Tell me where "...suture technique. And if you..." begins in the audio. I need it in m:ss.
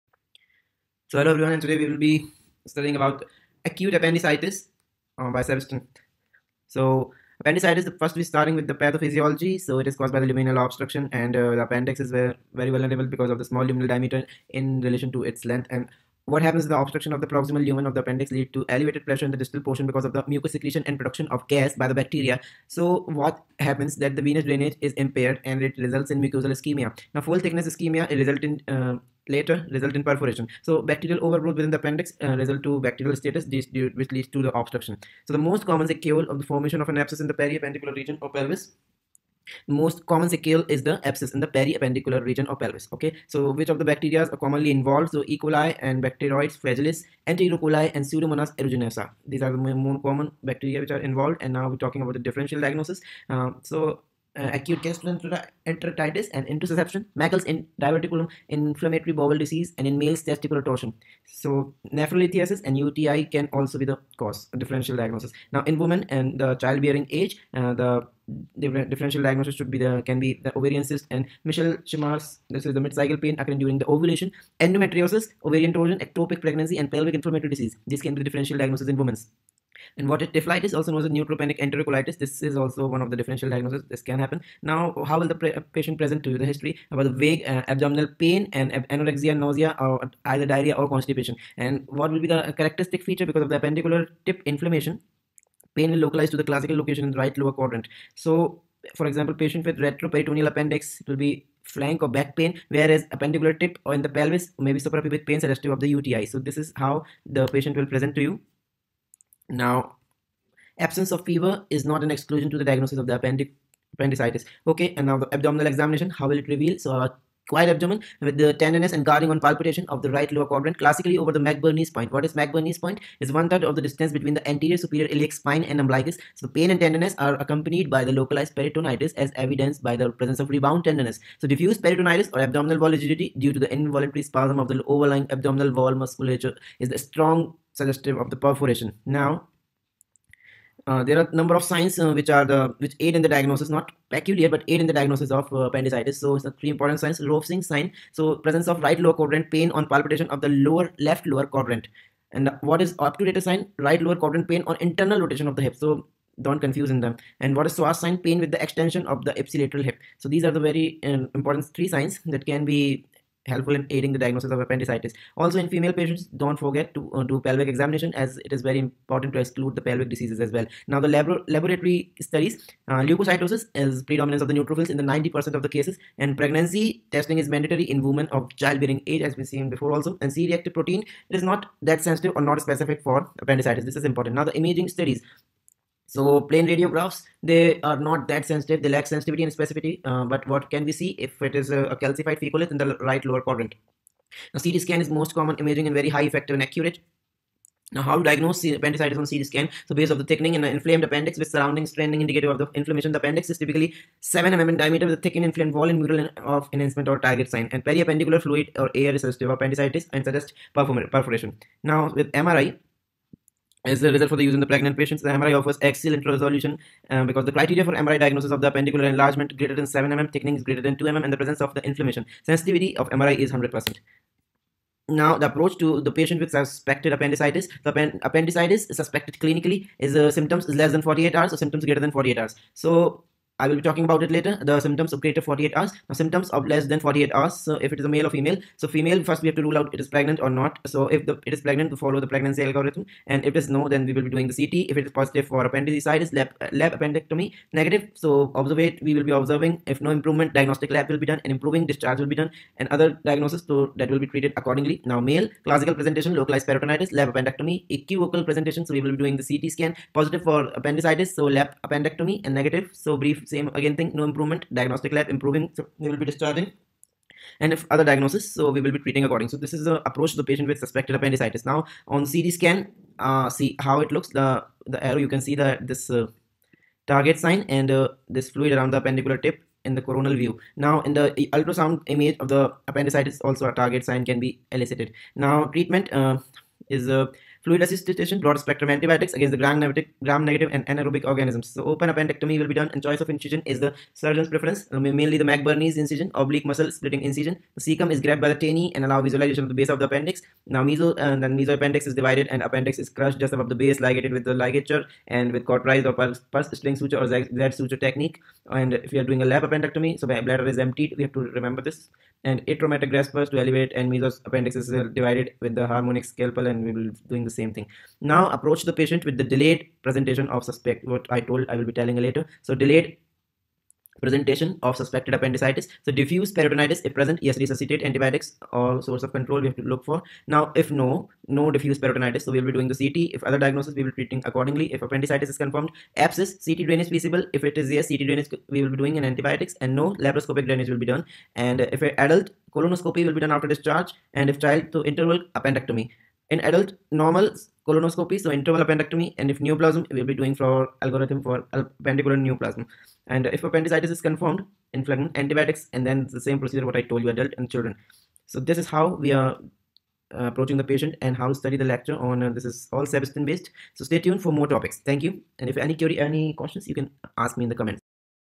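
5:07.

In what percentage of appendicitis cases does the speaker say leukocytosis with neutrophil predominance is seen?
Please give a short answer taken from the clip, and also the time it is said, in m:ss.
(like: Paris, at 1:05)
90%, at 2:55.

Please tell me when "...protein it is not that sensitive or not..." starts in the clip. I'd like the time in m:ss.
3:00.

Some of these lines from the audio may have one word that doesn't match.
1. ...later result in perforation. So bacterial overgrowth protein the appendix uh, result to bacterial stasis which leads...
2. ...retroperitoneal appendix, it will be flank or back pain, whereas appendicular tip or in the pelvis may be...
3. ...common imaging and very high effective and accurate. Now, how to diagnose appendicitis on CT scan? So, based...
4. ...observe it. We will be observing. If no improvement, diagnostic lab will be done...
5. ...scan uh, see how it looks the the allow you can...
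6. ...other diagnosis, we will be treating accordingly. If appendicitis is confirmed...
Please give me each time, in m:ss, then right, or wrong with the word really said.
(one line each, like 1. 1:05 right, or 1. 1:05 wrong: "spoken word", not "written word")
1. 0:29 wrong: "within", not "protein"
2. 1:39 right
3. 3:15 right
4. 4:08 right
5. 4:32 wrong: "arrow", not "allow"
6. 5:33 right.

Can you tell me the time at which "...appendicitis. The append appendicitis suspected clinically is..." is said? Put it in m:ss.
3:47.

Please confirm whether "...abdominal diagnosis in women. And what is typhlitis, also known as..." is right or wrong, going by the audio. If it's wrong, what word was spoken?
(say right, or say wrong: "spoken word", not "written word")
wrong: "differential", not "abdominal".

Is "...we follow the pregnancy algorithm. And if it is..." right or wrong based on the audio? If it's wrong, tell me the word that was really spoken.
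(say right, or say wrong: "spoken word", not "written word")
right.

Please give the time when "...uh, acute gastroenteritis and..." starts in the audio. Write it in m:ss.
0:54.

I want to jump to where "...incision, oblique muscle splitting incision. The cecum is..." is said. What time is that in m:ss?
4:55.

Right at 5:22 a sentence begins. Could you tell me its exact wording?
So delayed presentation of suspected appendicitis.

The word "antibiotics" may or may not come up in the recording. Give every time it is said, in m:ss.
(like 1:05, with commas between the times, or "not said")
4:48, 5:28, 5:39, 5:55.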